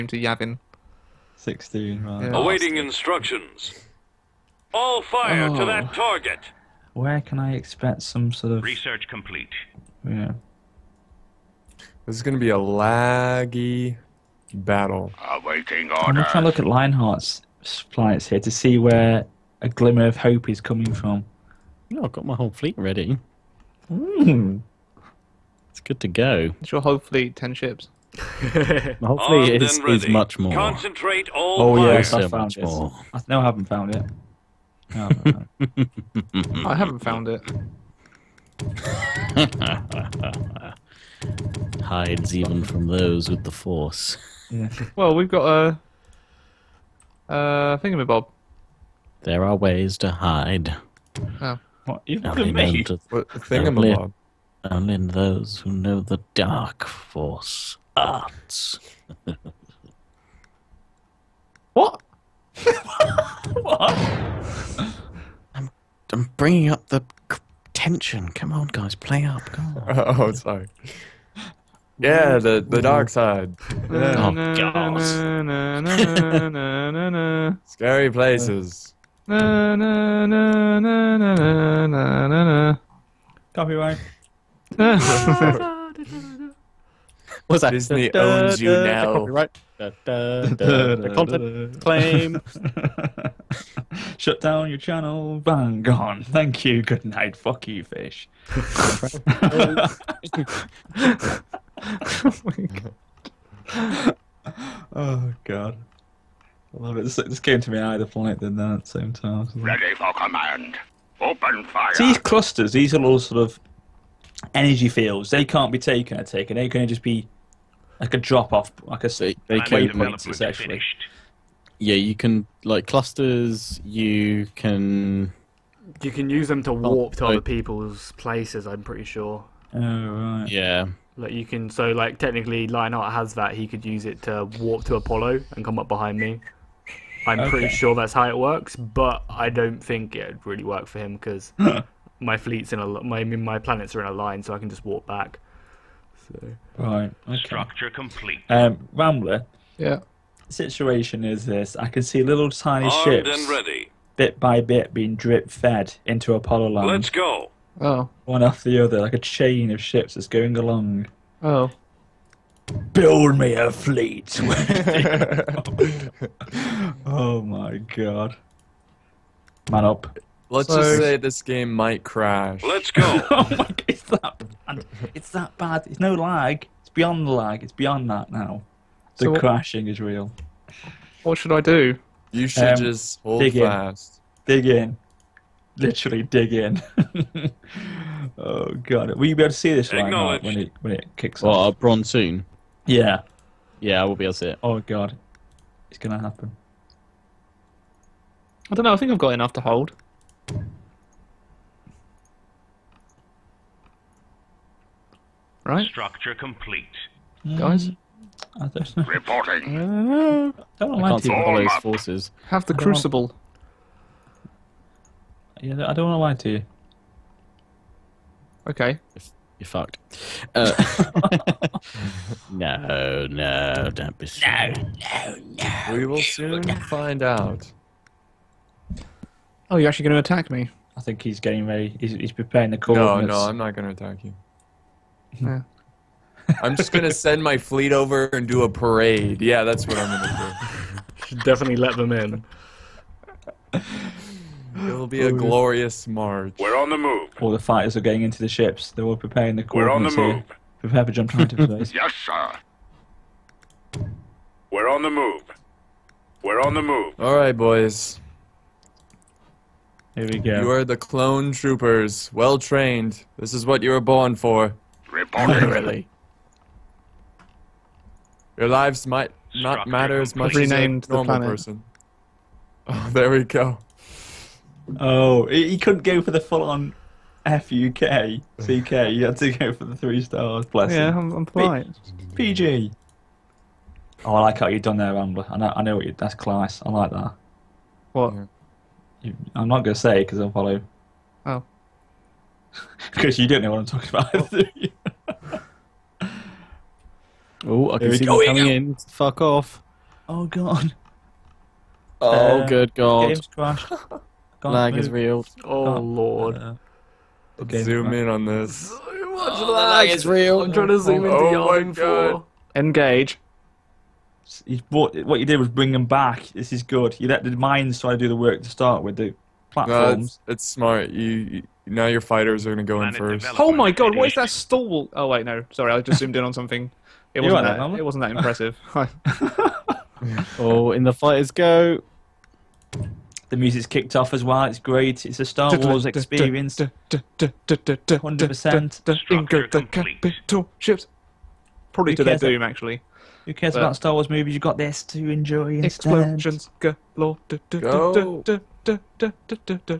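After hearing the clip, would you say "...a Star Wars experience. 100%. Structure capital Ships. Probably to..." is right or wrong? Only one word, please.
right.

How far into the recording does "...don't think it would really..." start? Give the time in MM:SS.
02:19.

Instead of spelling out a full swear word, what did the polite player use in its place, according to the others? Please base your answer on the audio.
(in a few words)
three stars.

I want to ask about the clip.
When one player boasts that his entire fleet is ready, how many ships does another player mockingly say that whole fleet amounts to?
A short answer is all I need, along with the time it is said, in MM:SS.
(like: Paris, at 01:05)
10, at 00:27.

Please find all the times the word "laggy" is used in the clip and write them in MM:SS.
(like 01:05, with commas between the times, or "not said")
00:12.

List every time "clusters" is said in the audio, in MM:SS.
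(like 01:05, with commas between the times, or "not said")
01:52, 02:02.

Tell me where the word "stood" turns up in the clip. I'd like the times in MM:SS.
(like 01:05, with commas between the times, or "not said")
not said.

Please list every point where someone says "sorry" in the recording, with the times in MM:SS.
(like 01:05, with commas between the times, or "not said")
01:10, 05:25.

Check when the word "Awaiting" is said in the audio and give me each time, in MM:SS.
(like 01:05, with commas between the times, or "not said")
00:02, 00:15.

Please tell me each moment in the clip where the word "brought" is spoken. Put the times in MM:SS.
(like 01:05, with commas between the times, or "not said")
05:14.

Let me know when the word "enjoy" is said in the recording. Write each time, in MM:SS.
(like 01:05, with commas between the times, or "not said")
05:45.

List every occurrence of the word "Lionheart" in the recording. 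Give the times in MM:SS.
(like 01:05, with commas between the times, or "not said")
00:16, 02:12.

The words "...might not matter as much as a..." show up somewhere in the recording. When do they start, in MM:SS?
04:29.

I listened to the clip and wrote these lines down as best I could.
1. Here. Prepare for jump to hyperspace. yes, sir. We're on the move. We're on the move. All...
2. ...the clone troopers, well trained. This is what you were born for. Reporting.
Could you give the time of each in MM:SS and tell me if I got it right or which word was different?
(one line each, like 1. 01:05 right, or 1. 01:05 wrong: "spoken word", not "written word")
1. 04:10 right
2. 04:20 right.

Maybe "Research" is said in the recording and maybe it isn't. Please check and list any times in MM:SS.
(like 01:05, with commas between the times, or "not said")
00:08.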